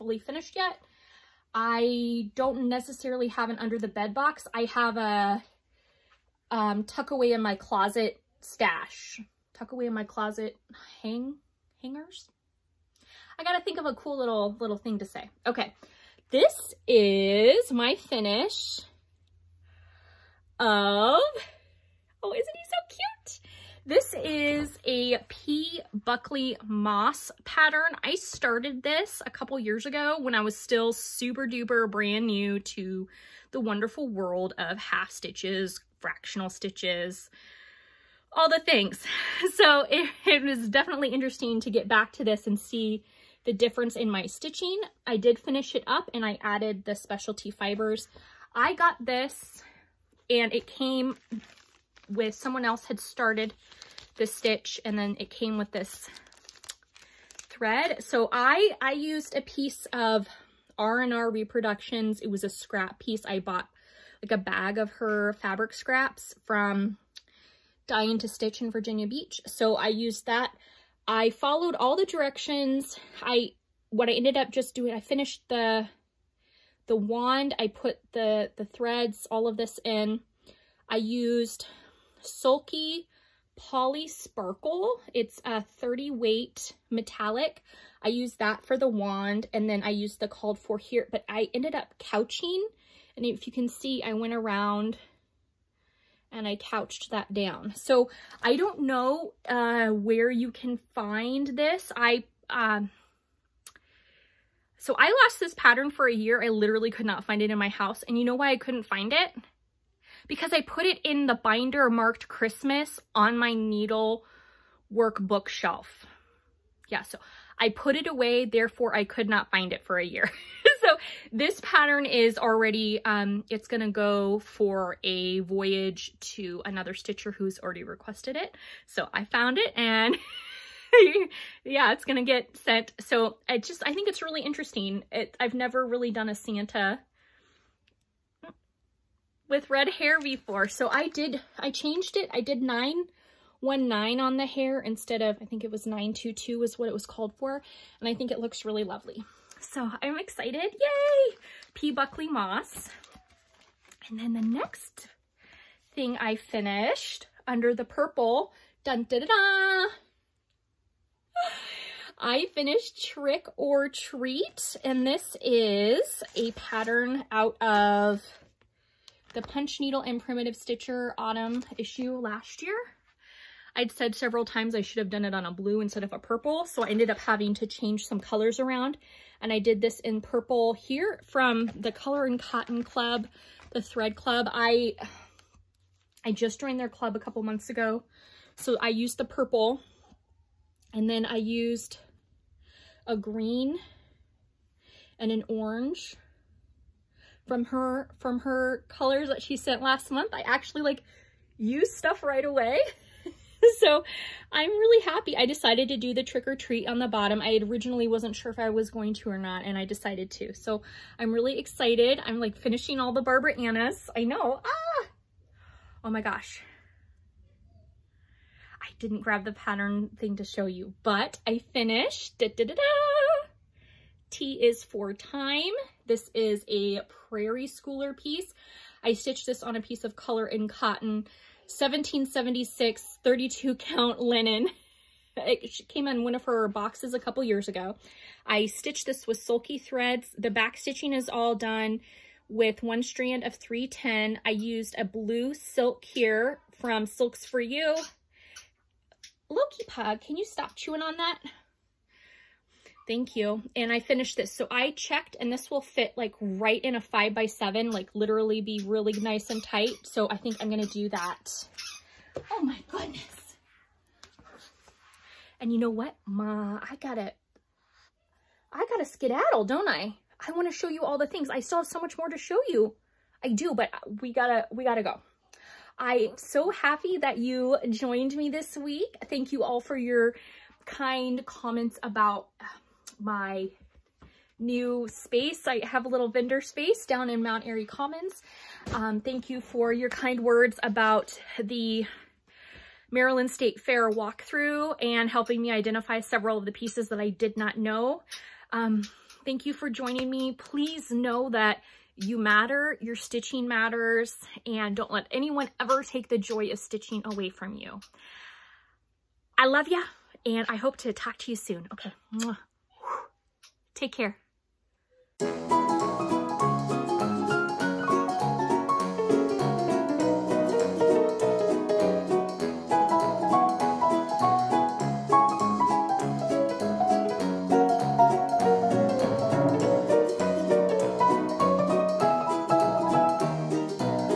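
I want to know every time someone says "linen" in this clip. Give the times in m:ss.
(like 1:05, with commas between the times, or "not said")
3:54.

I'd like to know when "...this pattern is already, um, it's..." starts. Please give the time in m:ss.
2:01.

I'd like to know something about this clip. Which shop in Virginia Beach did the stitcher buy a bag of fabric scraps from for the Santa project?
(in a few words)
Dye to Stitch.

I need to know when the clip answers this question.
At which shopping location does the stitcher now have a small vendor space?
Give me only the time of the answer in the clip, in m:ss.
4:47.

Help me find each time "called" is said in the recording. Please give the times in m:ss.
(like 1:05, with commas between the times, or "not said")
1:30, 2:27.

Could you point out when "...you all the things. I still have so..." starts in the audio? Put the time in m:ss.
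4:30.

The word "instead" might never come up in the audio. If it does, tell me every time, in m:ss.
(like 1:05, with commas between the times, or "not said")
2:24, 2:55.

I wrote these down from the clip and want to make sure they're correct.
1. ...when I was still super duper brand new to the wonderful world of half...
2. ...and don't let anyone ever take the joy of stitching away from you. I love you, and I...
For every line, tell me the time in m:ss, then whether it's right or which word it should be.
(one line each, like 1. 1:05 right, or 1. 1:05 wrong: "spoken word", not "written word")
1. 0:30 right
2. 5:04 right.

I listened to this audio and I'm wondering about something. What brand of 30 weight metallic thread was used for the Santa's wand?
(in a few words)
Sulky Poly Sparkle.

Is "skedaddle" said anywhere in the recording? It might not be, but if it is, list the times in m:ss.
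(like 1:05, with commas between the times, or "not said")
4:29.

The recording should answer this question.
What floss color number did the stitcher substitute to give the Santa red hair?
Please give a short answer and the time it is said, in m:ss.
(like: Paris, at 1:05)
919, at 2:22.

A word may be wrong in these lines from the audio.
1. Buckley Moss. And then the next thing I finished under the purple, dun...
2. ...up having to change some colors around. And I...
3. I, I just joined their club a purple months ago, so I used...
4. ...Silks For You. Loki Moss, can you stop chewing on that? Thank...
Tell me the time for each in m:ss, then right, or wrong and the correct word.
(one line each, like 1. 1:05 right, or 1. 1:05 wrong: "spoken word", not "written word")
1. 2:31 right
2. 2:57 right
3. 3:04 wrong: "couple", not "purple"
4. 4:07 wrong: "Pug", not "Moss".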